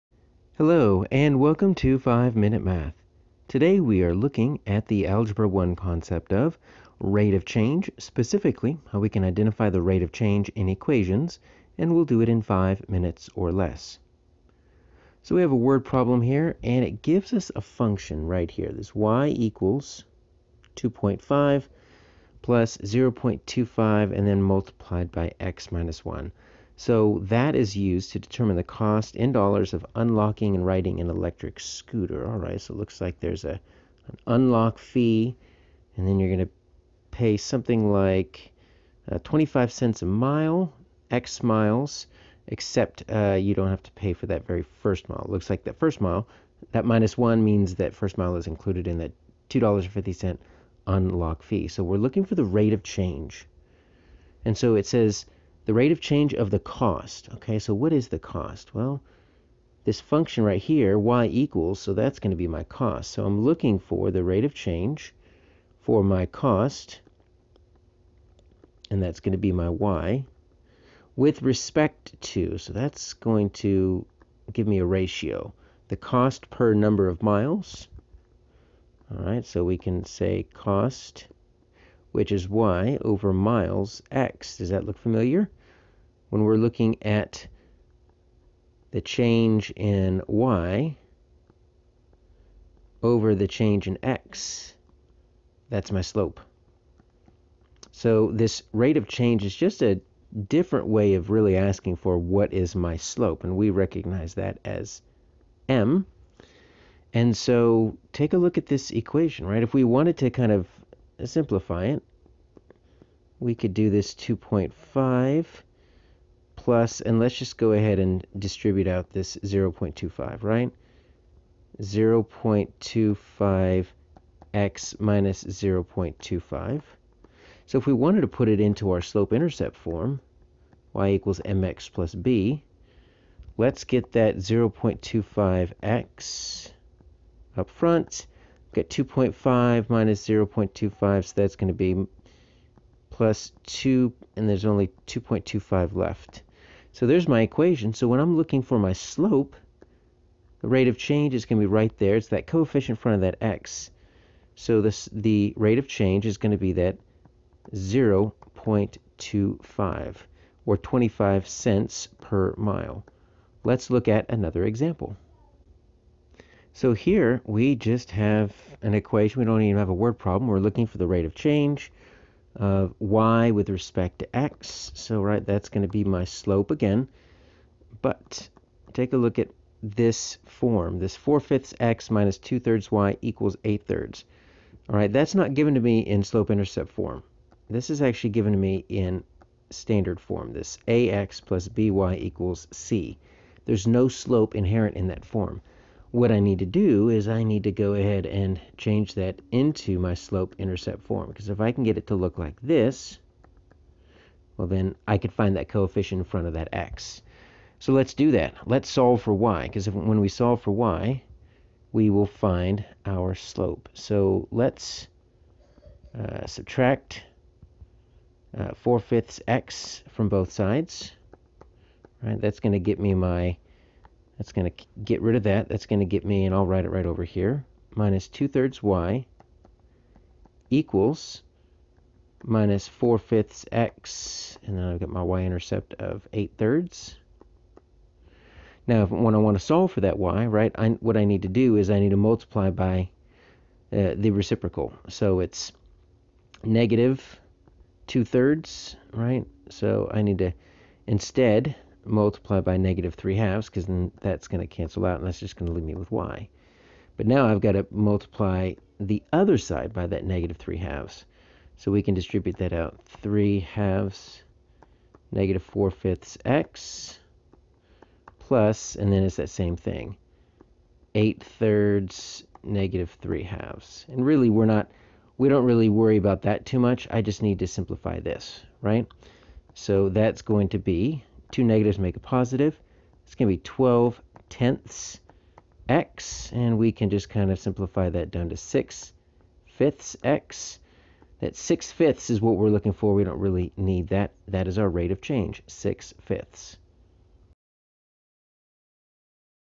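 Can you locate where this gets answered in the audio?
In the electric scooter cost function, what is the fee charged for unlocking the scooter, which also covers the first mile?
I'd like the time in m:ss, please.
0:49.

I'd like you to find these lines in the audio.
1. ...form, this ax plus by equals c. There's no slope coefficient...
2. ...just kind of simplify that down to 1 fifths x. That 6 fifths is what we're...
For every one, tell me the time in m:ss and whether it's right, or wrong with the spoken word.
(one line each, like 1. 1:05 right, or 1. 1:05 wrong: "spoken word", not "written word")
1. 3:10 wrong: "inherent", not "coefficient"
2. 4:47 wrong: "6", not "1".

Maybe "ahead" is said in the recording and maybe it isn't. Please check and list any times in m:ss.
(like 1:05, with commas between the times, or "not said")
1:57, 3:17.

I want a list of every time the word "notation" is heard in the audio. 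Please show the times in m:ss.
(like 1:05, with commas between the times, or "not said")
not said.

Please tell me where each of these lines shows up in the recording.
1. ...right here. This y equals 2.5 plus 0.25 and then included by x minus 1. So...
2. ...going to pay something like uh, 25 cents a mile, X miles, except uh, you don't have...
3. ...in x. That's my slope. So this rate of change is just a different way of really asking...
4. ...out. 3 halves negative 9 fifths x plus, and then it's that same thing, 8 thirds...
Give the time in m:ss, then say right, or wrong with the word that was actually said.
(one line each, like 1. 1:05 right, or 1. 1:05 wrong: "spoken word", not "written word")
1. 0:18 wrong: "multiplied", not "included"
2. 0:36 right
3. 1:33 right
4. 4:22 wrong: "4", not "9".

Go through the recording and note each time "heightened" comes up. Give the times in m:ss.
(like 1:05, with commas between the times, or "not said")
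not said.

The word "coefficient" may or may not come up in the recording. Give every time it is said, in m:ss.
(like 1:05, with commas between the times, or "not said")
2:32, 3:25.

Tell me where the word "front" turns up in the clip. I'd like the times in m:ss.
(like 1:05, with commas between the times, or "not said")
2:17, 2:33, 3:26.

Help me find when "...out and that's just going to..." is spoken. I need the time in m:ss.
4:15.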